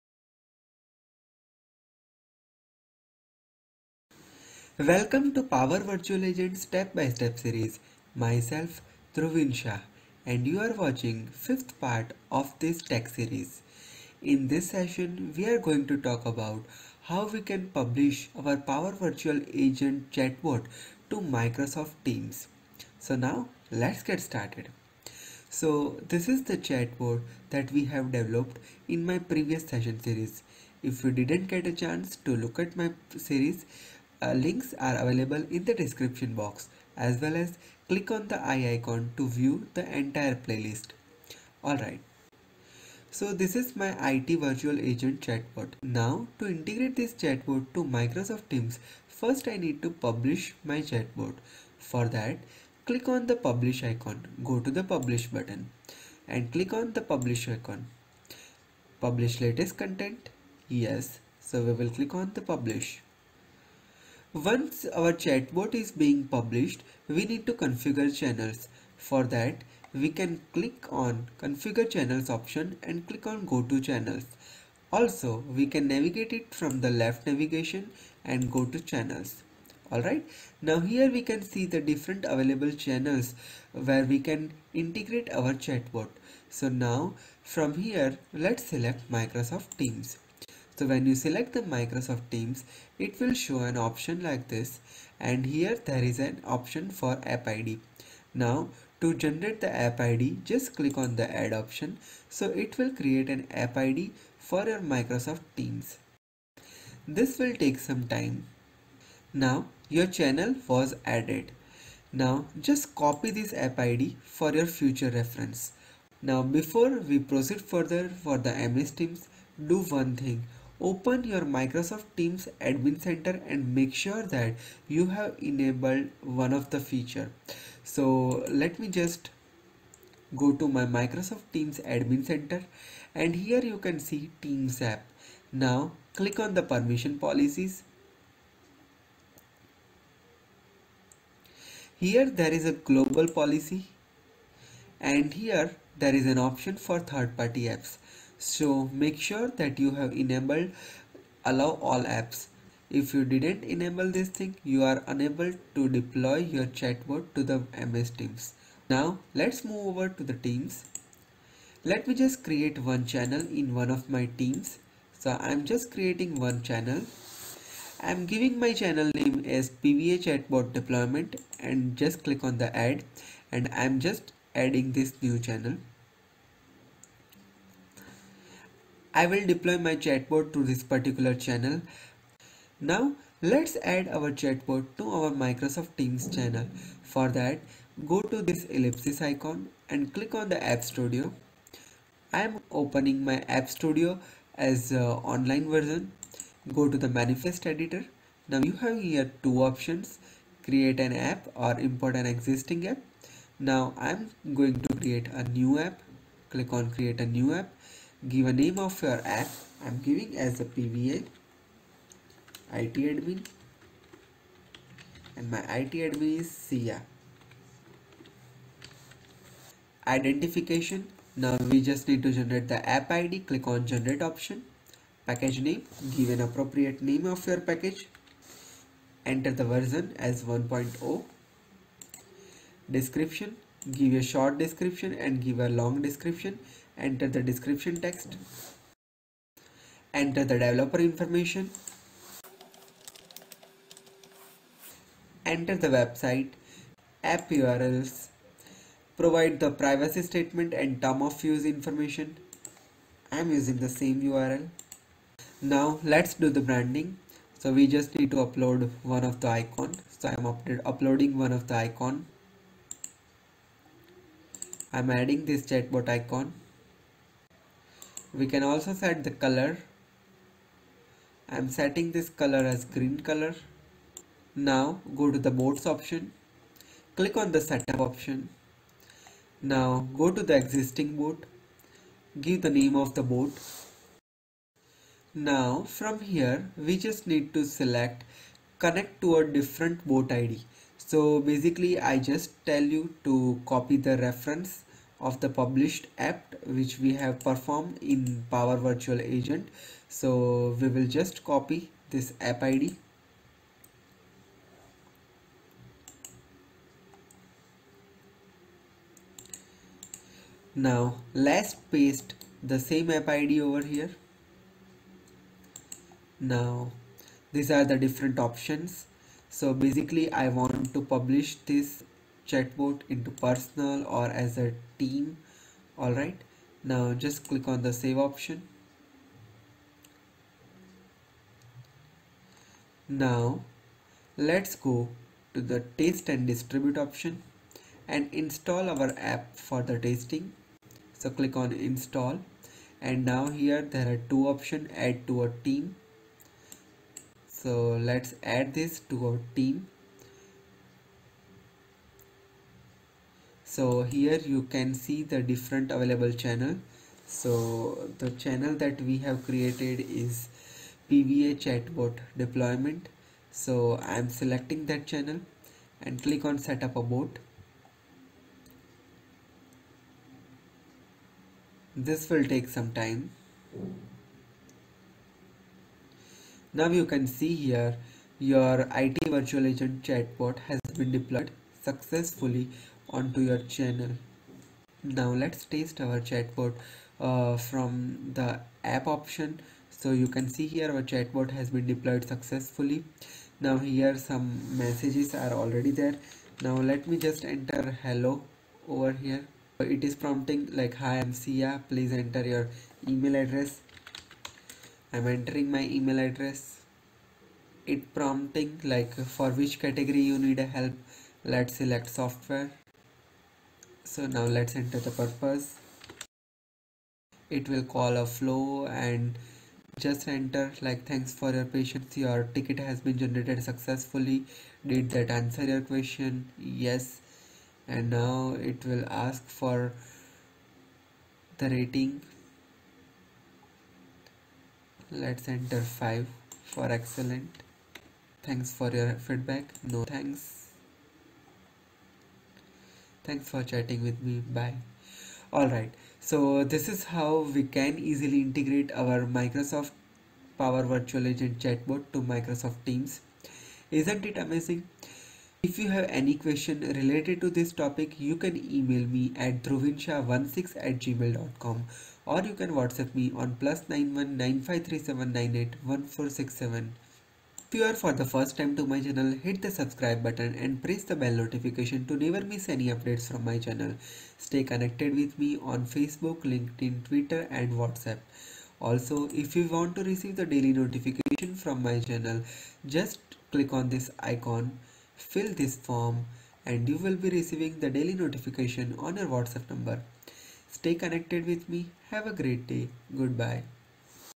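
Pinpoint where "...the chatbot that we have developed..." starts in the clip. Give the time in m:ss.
0:26.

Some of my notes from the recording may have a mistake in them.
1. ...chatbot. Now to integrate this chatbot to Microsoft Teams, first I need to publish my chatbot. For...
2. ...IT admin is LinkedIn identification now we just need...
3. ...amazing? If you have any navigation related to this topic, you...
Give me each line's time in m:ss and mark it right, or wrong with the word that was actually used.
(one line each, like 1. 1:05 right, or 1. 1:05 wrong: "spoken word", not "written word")
1. 0:45 right
2. 3:35 wrong: "SIA", not "LinkedIn"
3. 7:34 wrong: "question", not "navigation".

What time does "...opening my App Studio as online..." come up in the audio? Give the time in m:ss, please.
3:12.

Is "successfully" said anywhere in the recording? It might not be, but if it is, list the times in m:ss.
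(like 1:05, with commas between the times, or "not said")
6:21, 6:32, 7:03.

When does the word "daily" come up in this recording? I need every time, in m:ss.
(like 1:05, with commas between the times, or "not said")
8:00, 8:07.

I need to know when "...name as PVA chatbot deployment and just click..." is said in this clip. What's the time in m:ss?
2:49.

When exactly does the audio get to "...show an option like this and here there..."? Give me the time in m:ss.
1:33.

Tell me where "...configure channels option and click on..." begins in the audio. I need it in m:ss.
1:11.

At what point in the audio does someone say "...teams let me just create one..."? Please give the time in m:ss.
2:40.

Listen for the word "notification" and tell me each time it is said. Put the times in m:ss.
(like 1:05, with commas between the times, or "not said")
7:51, 8:00, 8:08.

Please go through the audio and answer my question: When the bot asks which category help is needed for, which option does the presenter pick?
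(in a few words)
Software.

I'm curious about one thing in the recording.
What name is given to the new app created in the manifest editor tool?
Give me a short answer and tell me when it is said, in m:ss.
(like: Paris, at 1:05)
PVA IT admin, at 3:30.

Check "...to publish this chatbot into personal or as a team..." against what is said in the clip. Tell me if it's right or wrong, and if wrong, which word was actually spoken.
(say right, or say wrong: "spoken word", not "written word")
right.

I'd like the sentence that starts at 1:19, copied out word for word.
Alright, now here we can see the different available channels where we can integrate our chatbot.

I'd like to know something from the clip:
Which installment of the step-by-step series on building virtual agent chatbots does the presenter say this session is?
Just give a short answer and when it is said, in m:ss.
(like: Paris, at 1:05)
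Fifth, at 0:11.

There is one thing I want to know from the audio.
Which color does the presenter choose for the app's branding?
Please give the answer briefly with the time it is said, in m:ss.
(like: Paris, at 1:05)
Green, at 4:32.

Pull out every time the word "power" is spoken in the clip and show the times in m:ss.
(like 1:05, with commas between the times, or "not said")
0:05, 0:18, 4:58, 7:30.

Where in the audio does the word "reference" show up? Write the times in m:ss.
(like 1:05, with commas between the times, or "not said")
1:55, 4:54.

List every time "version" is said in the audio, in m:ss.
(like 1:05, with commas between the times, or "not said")
3:15, 3:49.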